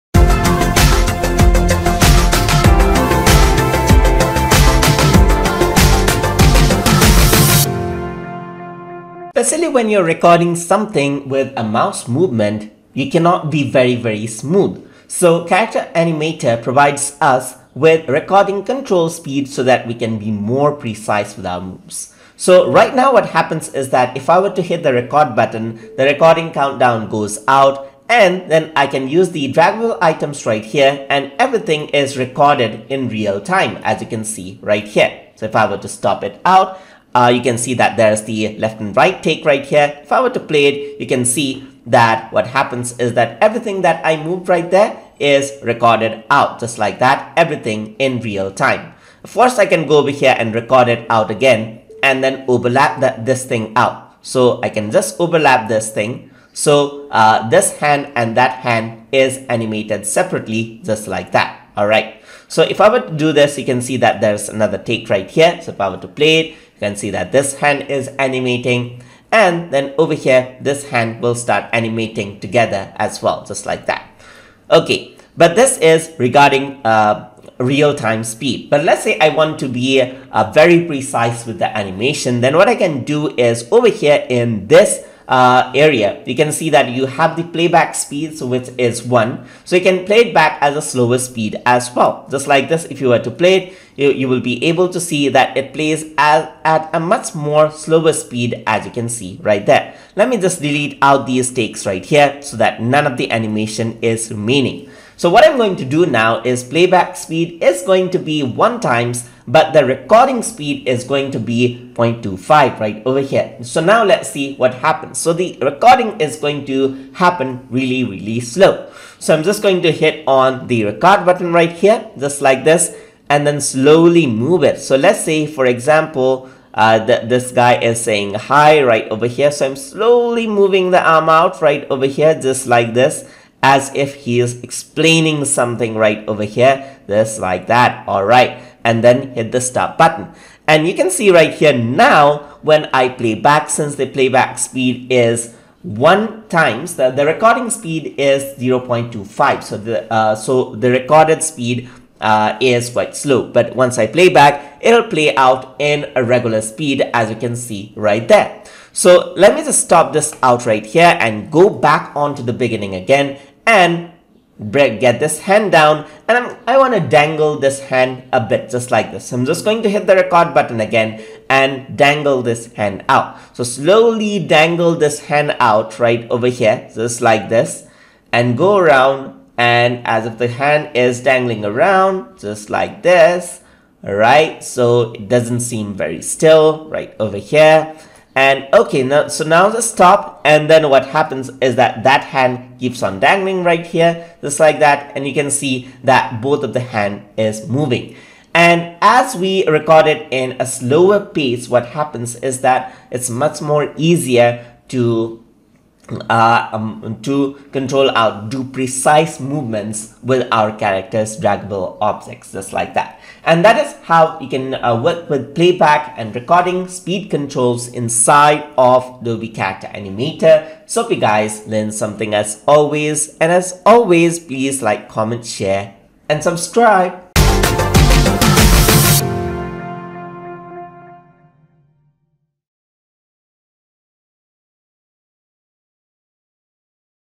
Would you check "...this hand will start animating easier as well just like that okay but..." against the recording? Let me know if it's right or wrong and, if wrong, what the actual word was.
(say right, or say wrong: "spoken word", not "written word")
wrong: "together", not "easier".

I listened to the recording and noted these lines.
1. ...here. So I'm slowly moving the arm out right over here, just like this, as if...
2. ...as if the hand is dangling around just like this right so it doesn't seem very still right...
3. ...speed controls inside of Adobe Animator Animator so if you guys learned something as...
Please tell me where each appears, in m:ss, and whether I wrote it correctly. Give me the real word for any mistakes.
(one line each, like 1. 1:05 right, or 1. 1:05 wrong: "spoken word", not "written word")
1. 2:09 right
2. 3:00 right
3. 3:36 wrong: "Character", not "Animator".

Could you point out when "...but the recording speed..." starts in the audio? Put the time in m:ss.
1:49.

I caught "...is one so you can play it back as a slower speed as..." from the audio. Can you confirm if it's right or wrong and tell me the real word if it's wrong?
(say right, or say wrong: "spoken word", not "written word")
right.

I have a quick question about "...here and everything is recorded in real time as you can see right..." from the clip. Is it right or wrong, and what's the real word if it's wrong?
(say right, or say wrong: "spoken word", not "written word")
right.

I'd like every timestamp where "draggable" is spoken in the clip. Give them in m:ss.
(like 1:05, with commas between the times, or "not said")
0:29, 3:31.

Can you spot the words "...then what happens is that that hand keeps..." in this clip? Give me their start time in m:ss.
3:10.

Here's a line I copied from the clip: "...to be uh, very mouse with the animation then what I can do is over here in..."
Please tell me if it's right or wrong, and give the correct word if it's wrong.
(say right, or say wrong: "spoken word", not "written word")
wrong: "precise", not "mouse".